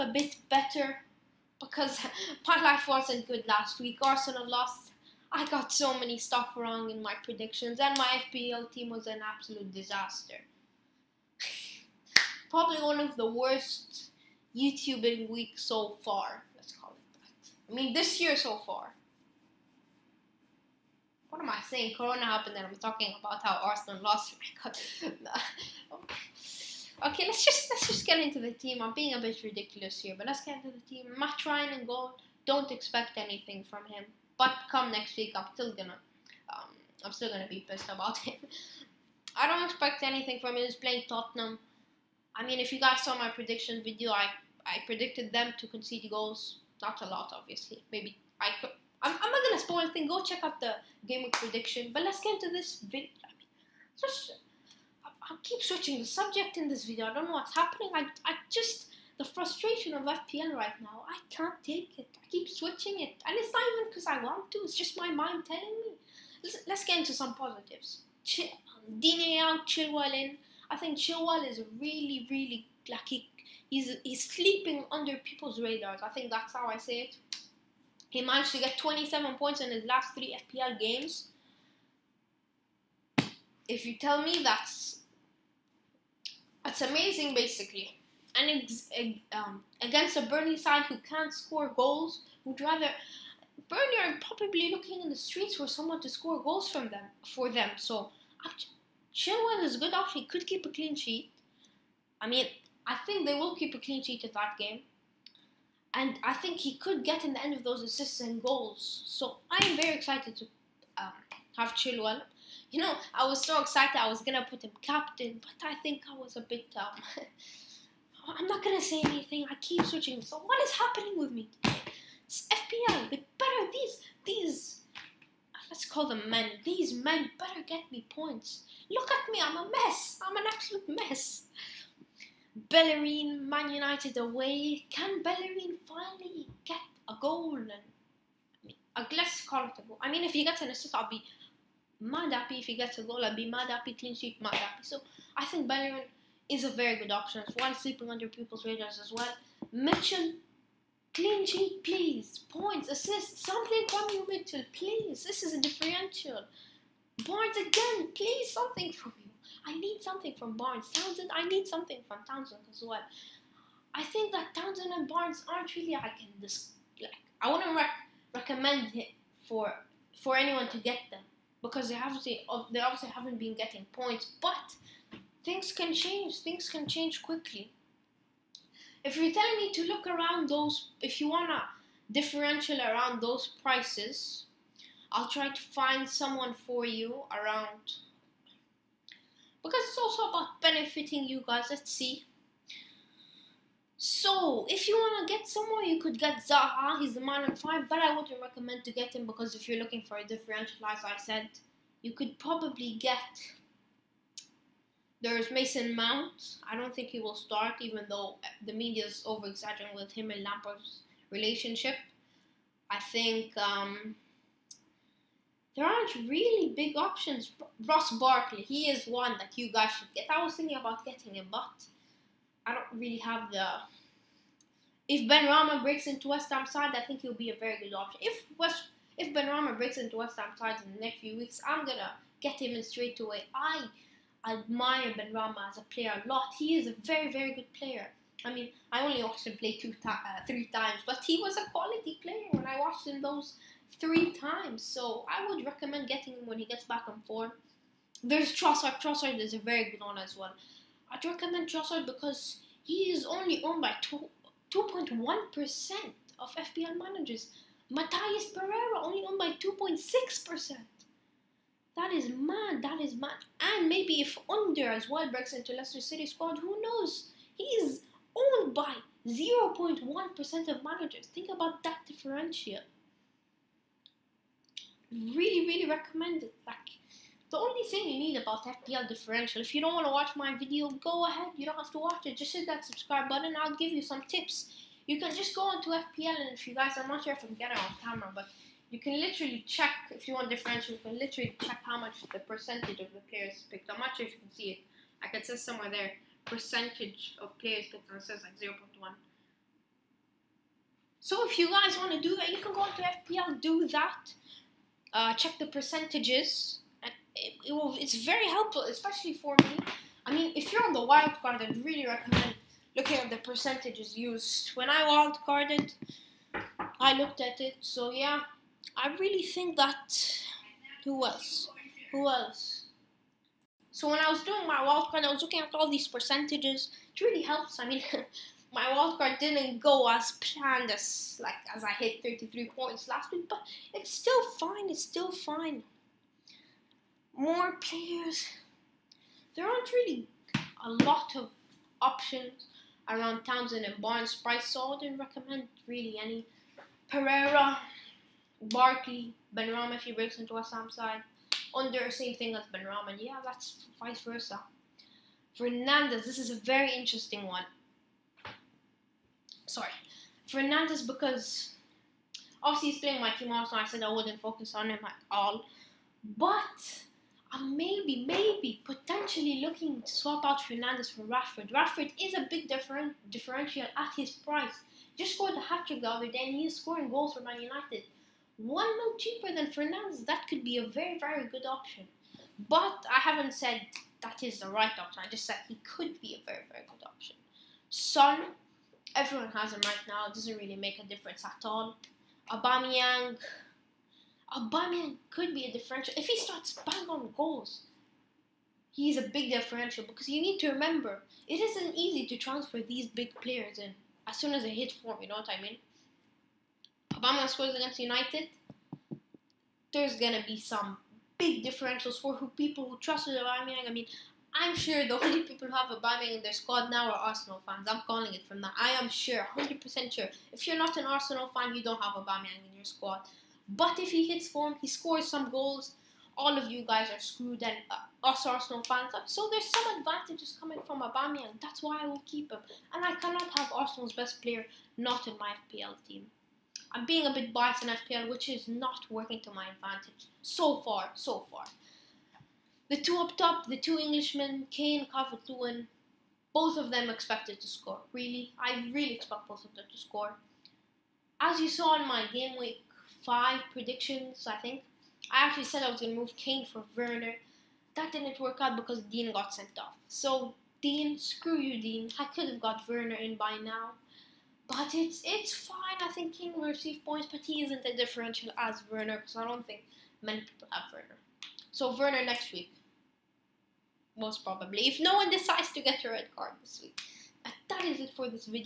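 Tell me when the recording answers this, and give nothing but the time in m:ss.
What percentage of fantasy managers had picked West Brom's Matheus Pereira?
4:19.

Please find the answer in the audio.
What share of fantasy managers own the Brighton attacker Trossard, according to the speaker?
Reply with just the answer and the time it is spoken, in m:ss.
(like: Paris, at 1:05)
2.1%, at 4:14.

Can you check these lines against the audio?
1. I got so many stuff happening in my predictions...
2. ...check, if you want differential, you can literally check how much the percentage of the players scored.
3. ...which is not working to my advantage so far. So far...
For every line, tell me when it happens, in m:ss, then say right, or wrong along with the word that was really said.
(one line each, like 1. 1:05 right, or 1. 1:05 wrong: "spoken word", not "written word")
1. 0:05 wrong: "wrong", not "happening"
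2. 4:49 wrong: "picked", not "scored"
3. 7:18 right.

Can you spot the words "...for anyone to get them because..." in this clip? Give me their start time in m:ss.
2:50.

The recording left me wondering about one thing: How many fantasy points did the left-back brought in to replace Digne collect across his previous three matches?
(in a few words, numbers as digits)
27.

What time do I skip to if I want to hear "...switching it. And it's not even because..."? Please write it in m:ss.
1:02.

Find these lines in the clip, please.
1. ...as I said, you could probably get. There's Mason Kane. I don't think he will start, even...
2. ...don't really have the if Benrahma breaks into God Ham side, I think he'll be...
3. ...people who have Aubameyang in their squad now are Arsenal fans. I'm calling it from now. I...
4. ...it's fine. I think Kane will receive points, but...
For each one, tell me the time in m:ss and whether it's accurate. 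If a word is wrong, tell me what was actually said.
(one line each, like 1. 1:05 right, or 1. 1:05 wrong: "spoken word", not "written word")
1. 3:20 wrong: "Mount", not "Kane"
2. 3:42 wrong: "West", not "God"
3. 6:55 right
4. 7:45 right.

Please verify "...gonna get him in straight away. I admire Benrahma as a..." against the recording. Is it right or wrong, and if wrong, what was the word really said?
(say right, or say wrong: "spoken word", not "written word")
right.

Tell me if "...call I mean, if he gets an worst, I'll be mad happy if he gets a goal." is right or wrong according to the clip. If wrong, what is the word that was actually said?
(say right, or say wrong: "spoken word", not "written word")
wrong: "assist", not "worst".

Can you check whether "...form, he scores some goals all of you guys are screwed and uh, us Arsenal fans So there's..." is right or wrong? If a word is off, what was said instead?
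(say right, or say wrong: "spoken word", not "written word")
right.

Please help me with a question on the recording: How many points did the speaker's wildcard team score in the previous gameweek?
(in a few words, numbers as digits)
33.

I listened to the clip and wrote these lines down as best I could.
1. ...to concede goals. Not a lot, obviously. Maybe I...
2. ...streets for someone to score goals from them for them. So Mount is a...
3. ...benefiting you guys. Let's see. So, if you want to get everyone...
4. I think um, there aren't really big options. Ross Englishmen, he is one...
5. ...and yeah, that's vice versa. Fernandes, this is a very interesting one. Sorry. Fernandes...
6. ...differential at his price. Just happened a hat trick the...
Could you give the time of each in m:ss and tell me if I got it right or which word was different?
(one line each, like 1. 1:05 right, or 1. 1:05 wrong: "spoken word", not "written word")
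1. 0:45 right
2. 1:35 wrong: "Chilwell", not "Mount"
3. 3:10 wrong: "someone", not "everyone"
4. 3:32 wrong: "Barkley", not "Englishmen"
5. 5:53 right
6. 6:13 wrong: "scored", not "happened".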